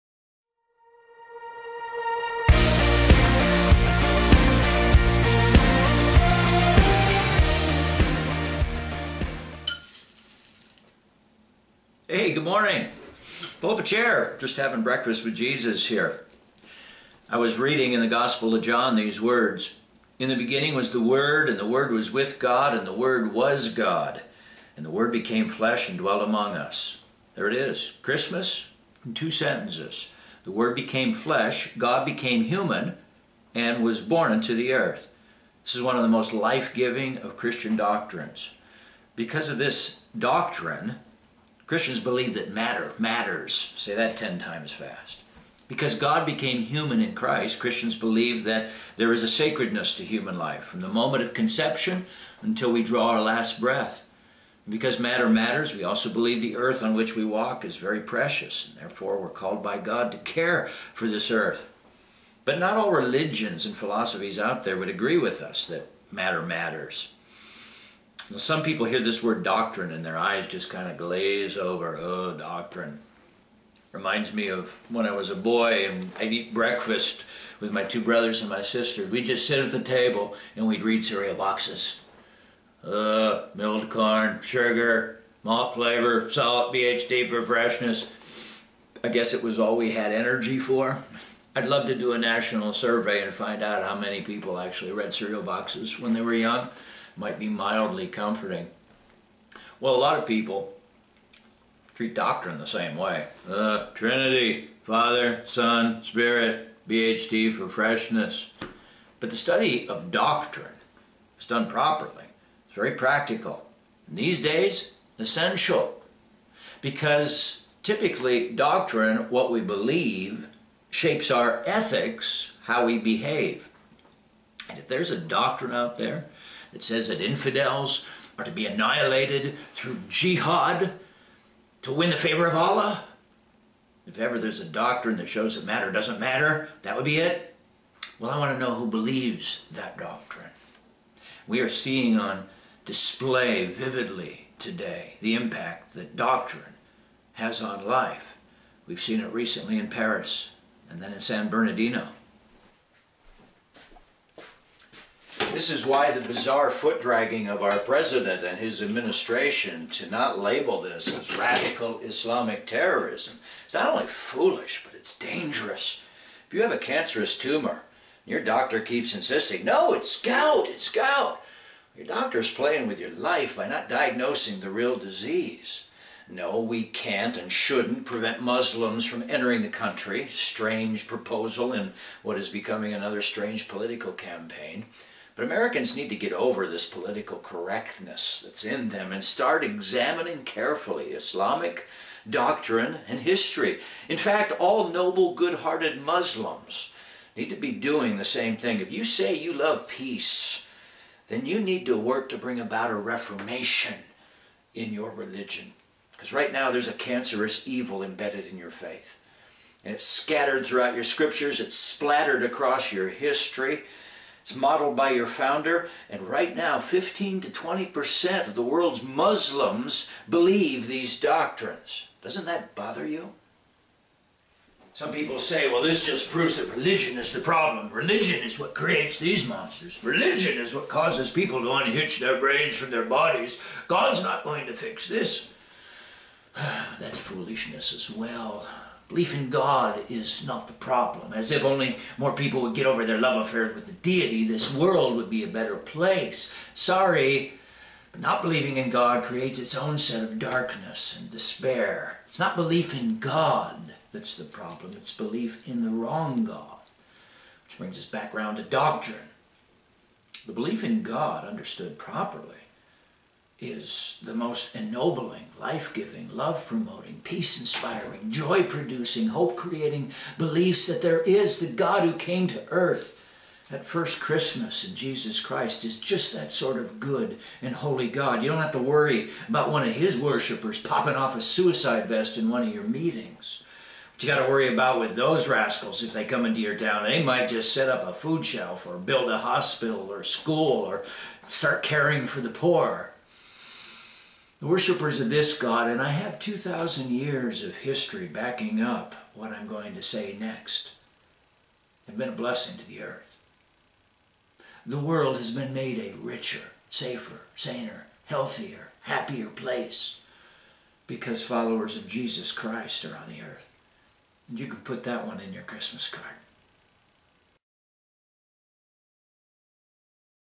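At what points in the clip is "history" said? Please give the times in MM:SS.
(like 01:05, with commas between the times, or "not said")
03:13, 03:33, 04:57.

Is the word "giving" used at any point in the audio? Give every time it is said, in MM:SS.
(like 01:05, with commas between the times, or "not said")
00:36, 04:25.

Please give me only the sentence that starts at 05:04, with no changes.
The world has been made a richer, safer, saner, healthier, happier place because followers of Jesus Christ are on the earth.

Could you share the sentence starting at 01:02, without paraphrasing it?
But not all religions and philosophies out there would agree with us that matter matters.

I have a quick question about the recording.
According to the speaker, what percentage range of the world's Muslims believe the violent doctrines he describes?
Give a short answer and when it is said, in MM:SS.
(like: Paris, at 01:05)
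15 to 20%, at 03:36.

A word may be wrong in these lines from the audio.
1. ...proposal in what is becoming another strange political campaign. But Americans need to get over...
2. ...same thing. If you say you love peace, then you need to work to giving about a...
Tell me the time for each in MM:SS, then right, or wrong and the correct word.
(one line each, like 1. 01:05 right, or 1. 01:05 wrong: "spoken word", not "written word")
1. 03:01 right
2. 03:18 wrong: "bring", not "giving".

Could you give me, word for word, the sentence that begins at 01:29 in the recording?
I guess it was all we had energy for.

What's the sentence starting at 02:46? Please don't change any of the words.
If you have a cancerous tumor, your doctor keeps insisting, no, it's gout, it's gout.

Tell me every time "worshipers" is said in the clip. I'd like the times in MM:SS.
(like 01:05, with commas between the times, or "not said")
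04:40, 04:54.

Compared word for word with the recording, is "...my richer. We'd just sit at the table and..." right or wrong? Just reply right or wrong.
wrong.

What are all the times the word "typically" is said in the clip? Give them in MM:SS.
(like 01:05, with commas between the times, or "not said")
01:57.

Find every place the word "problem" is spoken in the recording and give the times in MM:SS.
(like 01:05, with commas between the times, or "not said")
03:47, 04:00, 04:14.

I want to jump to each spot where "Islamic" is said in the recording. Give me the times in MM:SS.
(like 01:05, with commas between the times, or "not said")
02:41, 03:11.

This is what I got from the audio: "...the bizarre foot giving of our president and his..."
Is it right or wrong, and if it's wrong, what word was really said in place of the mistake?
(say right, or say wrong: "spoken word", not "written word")
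wrong: "dragging", not "giving".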